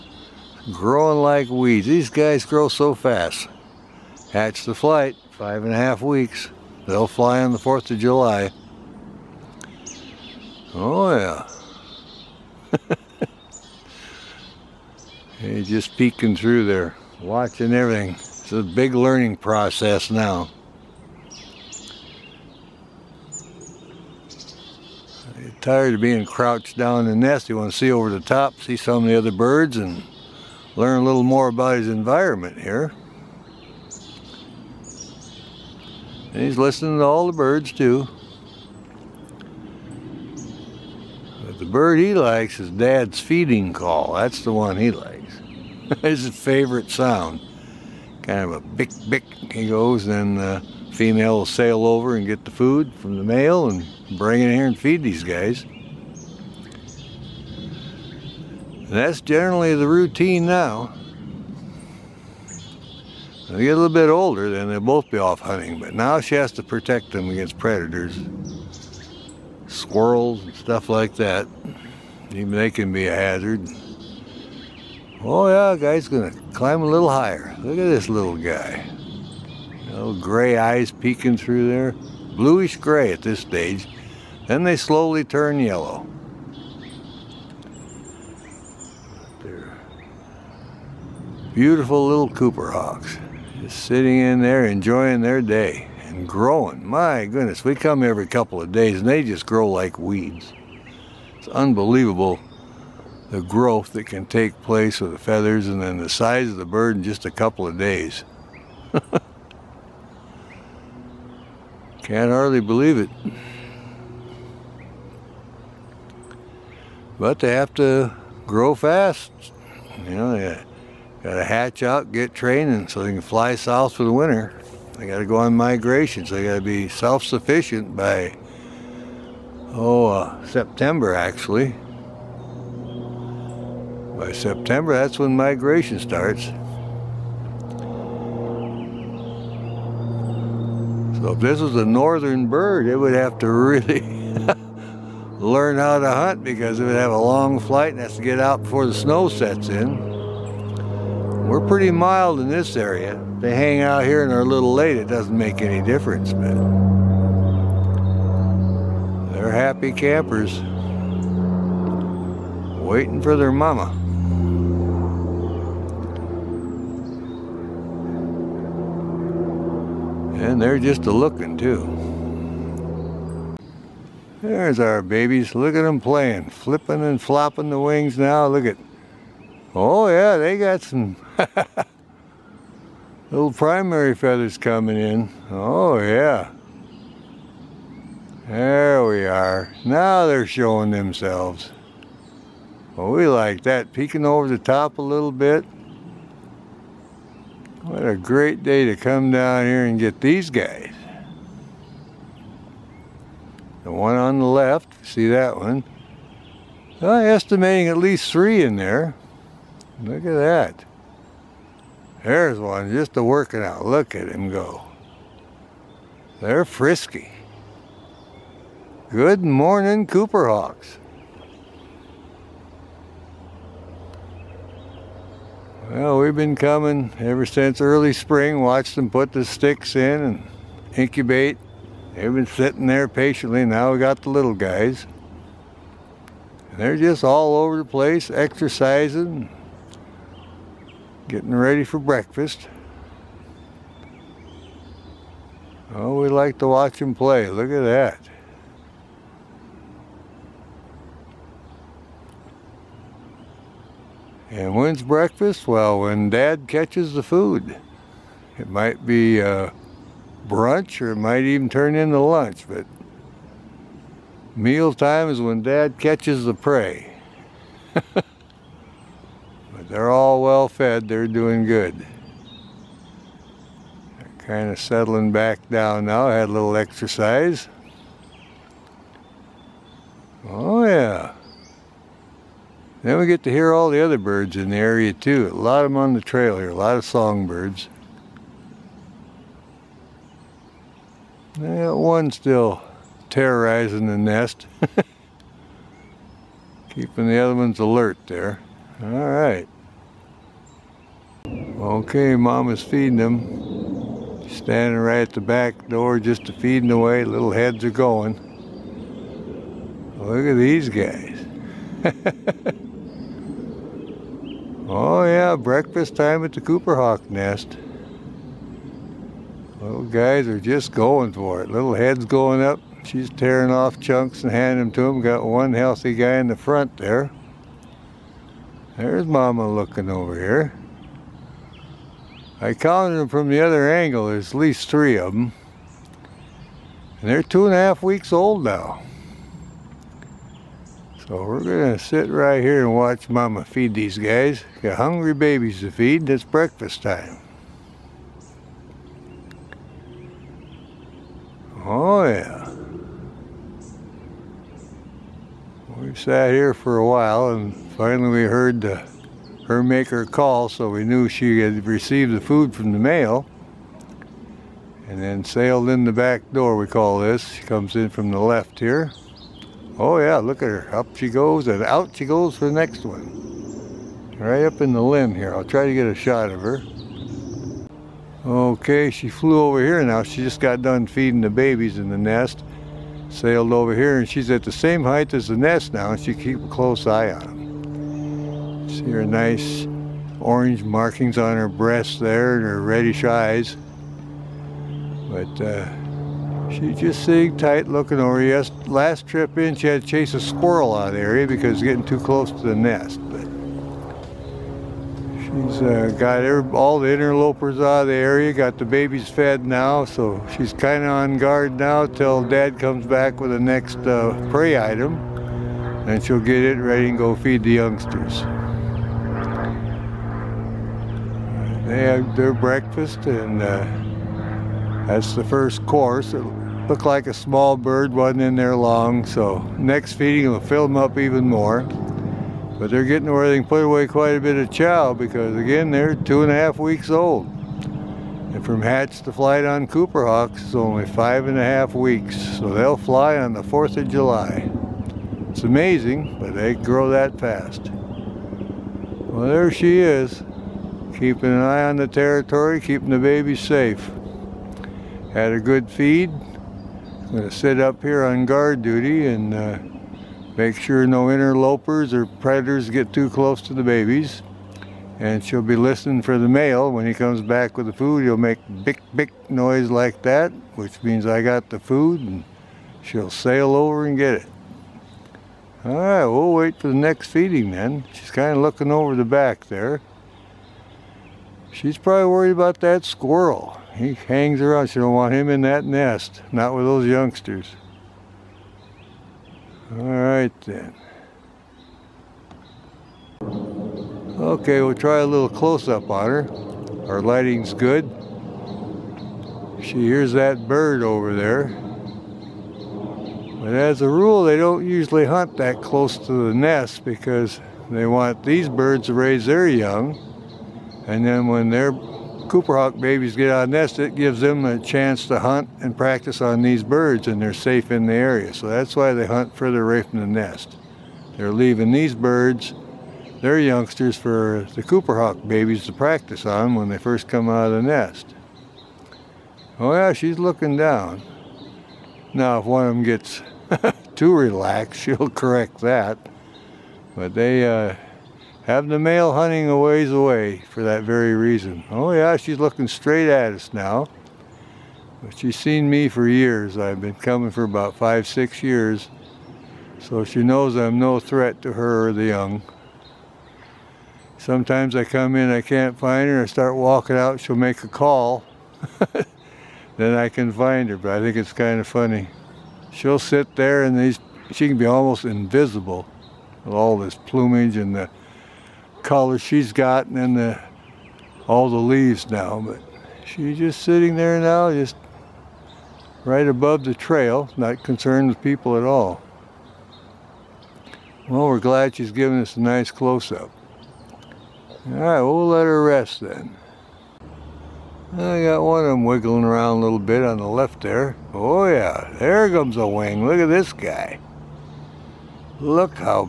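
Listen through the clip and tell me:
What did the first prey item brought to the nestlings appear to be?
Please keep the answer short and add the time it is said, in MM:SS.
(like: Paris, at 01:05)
a small bird, at 07:07.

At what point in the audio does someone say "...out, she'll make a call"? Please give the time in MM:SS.
09:17.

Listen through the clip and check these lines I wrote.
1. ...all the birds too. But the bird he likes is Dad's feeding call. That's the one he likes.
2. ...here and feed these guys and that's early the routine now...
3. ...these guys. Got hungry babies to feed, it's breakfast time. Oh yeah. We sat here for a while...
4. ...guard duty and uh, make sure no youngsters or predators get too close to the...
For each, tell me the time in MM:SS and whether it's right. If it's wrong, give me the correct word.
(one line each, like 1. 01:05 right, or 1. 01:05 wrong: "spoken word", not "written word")
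1. 00:37 right
2. 00:54 wrong: "generally", not "early"
3. 05:43 right
4. 07:38 wrong: "interlopers", not "youngsters".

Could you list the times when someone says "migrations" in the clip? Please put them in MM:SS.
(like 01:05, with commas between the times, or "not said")
02:05, 02:15.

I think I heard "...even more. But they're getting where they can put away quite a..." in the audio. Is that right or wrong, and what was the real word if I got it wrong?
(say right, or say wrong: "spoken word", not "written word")
right.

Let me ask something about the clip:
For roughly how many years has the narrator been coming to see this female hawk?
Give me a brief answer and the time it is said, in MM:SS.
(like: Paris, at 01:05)
5 to 6 years, at 09:07.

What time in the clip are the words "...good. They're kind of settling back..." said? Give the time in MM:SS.
04:31.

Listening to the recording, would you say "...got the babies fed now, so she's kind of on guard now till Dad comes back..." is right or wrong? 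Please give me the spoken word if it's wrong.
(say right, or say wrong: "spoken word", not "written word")
right.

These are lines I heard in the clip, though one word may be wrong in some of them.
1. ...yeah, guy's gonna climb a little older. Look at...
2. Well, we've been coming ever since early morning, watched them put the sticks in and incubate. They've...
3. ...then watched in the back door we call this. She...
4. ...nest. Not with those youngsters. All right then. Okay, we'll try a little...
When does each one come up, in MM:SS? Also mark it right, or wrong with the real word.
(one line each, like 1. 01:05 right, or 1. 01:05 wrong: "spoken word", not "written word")
1. 01:15 wrong: "higher", not "older"
2. 03:45 wrong: "spring", not "morning"
3. 06:05 wrong: "sailed", not "watched"
4. 08:05 right.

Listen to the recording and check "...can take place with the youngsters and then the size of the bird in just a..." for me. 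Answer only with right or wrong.
wrong.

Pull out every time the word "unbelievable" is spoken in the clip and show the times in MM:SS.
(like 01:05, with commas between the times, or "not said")
01:41.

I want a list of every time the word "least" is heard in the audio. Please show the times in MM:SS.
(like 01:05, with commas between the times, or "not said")
03:27, 05:34.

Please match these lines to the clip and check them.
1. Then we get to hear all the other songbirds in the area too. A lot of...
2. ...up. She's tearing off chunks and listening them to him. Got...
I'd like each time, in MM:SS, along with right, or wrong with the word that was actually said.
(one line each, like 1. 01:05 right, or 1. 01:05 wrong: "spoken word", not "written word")
1. 04:43 wrong: "birds", not "songbirds"
2. 05:22 wrong: "handing", not "listening".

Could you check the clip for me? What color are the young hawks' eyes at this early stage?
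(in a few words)
Bluish gray.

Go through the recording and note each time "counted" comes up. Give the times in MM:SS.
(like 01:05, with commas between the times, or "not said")
05:32.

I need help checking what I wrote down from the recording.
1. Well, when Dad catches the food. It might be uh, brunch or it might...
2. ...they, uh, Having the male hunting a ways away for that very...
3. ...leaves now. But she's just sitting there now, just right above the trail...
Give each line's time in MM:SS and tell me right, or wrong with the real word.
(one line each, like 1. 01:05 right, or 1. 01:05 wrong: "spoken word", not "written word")
1. 04:15 right
2. 08:57 right
3. 09:31 right.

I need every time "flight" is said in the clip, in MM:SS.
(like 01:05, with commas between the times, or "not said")
00:04, 02:27, 07:19.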